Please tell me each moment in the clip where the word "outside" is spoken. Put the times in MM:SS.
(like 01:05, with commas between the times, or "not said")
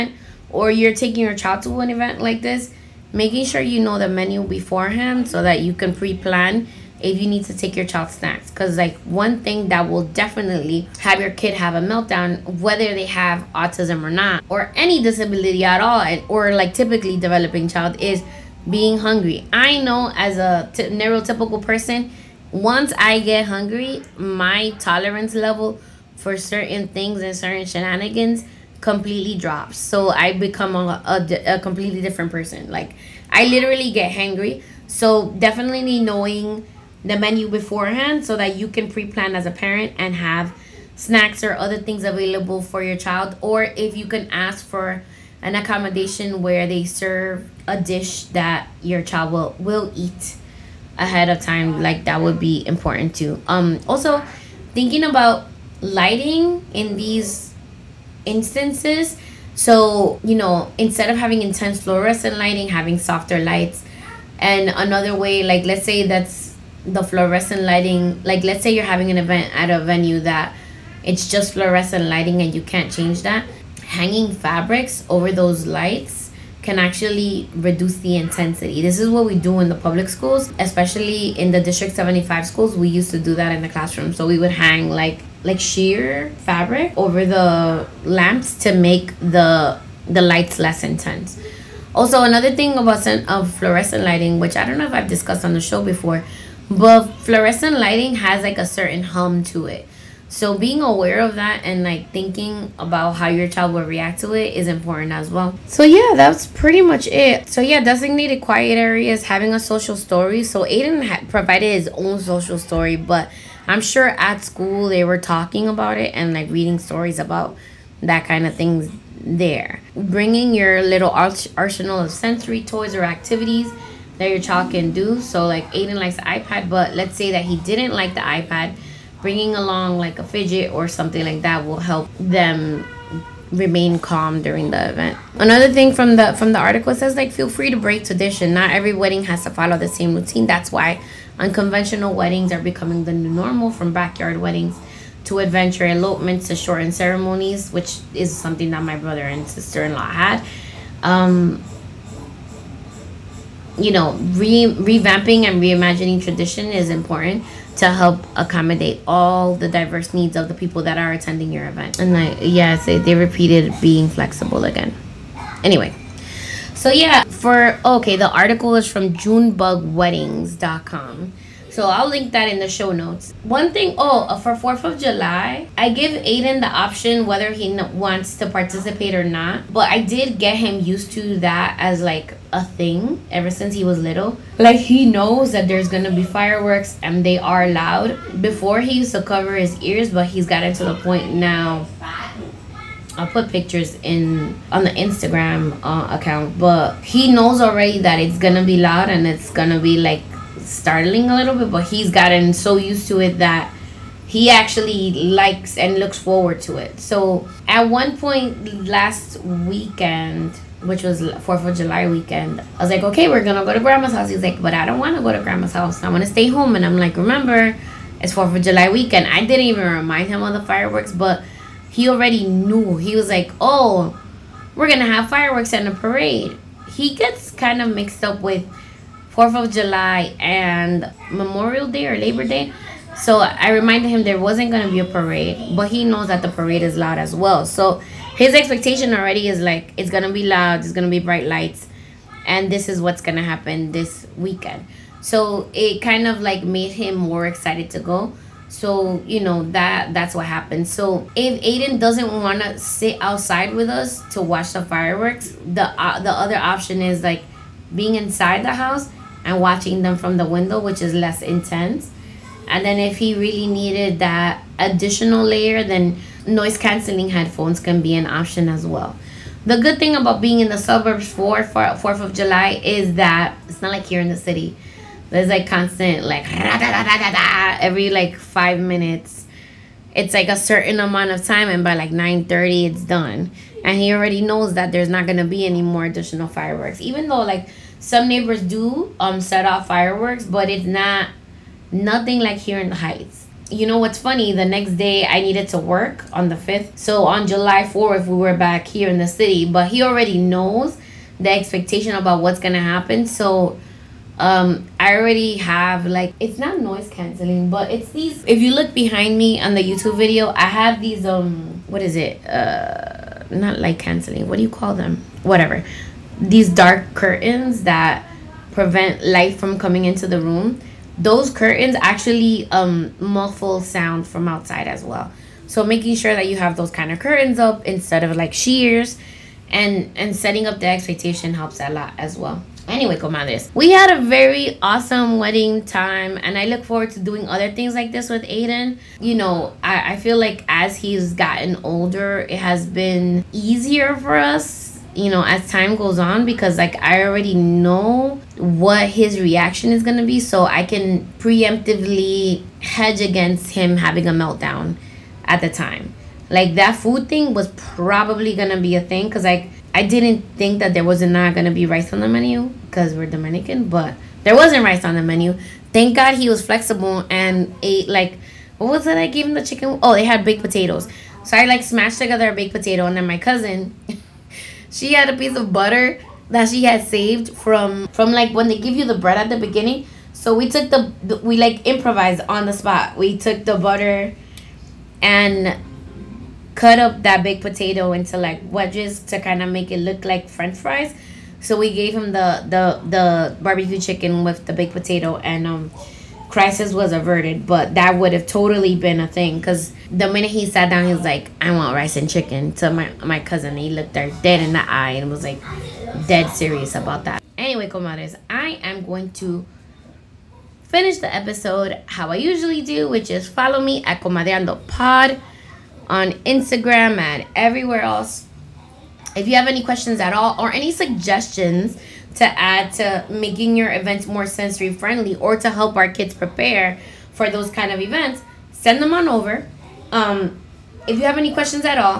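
04:13, 05:24.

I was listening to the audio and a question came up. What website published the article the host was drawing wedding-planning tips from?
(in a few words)
junebugweddings.com.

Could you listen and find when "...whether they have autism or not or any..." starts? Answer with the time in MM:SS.
00:12.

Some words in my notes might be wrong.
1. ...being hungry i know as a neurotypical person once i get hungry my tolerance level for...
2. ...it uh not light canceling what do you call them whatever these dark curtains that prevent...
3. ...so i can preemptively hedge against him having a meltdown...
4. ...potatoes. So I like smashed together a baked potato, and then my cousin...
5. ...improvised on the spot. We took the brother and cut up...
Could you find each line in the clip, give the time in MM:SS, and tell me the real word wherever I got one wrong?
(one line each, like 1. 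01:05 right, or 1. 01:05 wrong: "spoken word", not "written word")
1. 00:18 right
2. 05:12 right
3. 05:50 right
4. 06:10 right
5. 06:21 wrong: "butter", not "brother".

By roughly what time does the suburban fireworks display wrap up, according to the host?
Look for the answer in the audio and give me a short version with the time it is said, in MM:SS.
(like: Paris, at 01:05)
9:30, at 04:42.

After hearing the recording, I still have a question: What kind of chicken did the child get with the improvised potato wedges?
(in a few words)
Barbecue chicken.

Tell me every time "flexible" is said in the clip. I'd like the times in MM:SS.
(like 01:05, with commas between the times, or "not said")
02:44, 06:06.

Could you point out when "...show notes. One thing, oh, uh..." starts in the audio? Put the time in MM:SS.
02:52.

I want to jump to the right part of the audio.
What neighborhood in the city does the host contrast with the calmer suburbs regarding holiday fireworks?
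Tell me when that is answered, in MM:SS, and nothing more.
04:52.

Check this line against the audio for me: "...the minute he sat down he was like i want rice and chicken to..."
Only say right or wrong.
right.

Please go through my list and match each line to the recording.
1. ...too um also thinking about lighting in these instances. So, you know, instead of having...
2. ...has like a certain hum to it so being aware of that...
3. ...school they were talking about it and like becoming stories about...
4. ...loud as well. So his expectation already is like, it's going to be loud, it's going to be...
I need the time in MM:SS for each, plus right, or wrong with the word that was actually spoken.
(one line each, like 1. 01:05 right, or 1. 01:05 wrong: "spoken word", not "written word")
1. 00:53 right
2. 01:38 right
3. 01:54 wrong: "reading", not "becoming"
4. 03:56 right.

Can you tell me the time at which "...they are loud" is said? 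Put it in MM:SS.
03:07.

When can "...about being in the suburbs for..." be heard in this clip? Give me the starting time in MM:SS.
04:30.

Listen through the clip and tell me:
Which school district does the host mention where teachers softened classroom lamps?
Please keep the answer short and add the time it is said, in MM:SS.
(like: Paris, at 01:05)
District 75, at 01:21.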